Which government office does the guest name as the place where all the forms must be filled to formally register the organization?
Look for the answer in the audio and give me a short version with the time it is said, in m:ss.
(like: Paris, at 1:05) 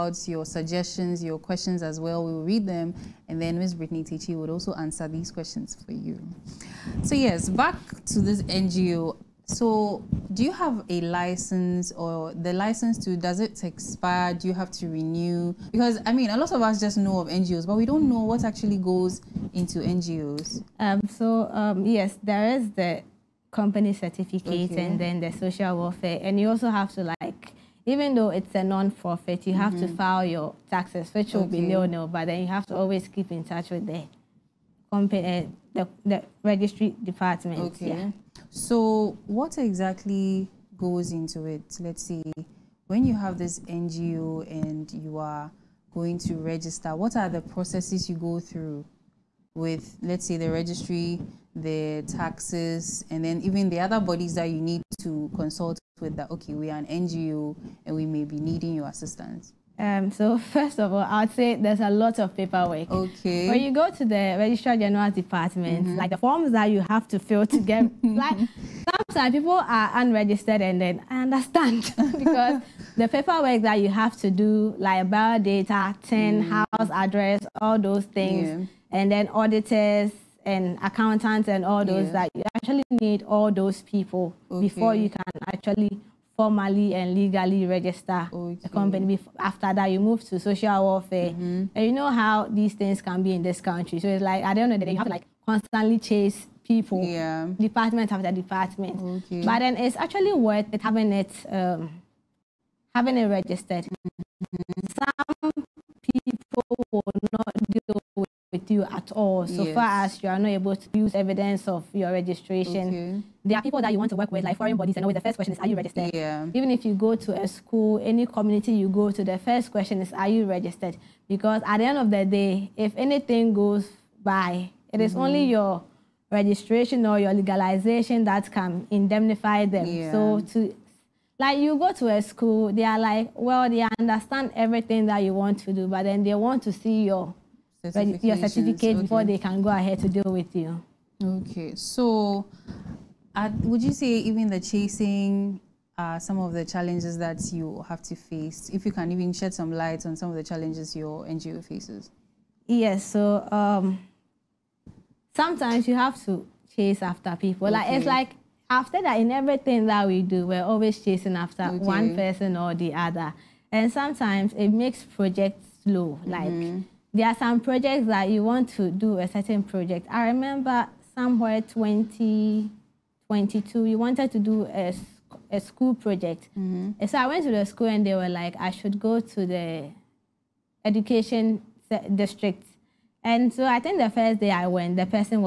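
Registrar General's Department, at 1:04.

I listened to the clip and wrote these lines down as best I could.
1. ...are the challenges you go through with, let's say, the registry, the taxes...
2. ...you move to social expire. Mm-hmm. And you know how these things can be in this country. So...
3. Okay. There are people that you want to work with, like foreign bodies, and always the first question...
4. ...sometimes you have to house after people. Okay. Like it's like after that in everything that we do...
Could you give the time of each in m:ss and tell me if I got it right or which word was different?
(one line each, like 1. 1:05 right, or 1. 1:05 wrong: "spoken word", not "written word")
1. 0:47 wrong: "processes", not "challenges"
2. 1:29 wrong: "welfare", not "expire"
3. 1:52 right
4. 2:35 wrong: "chase", not "house".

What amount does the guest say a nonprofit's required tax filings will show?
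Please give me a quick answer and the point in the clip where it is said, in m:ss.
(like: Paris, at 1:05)
nil, at 0:31.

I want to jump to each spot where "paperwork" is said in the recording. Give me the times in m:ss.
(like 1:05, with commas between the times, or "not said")
1:02, 1:13.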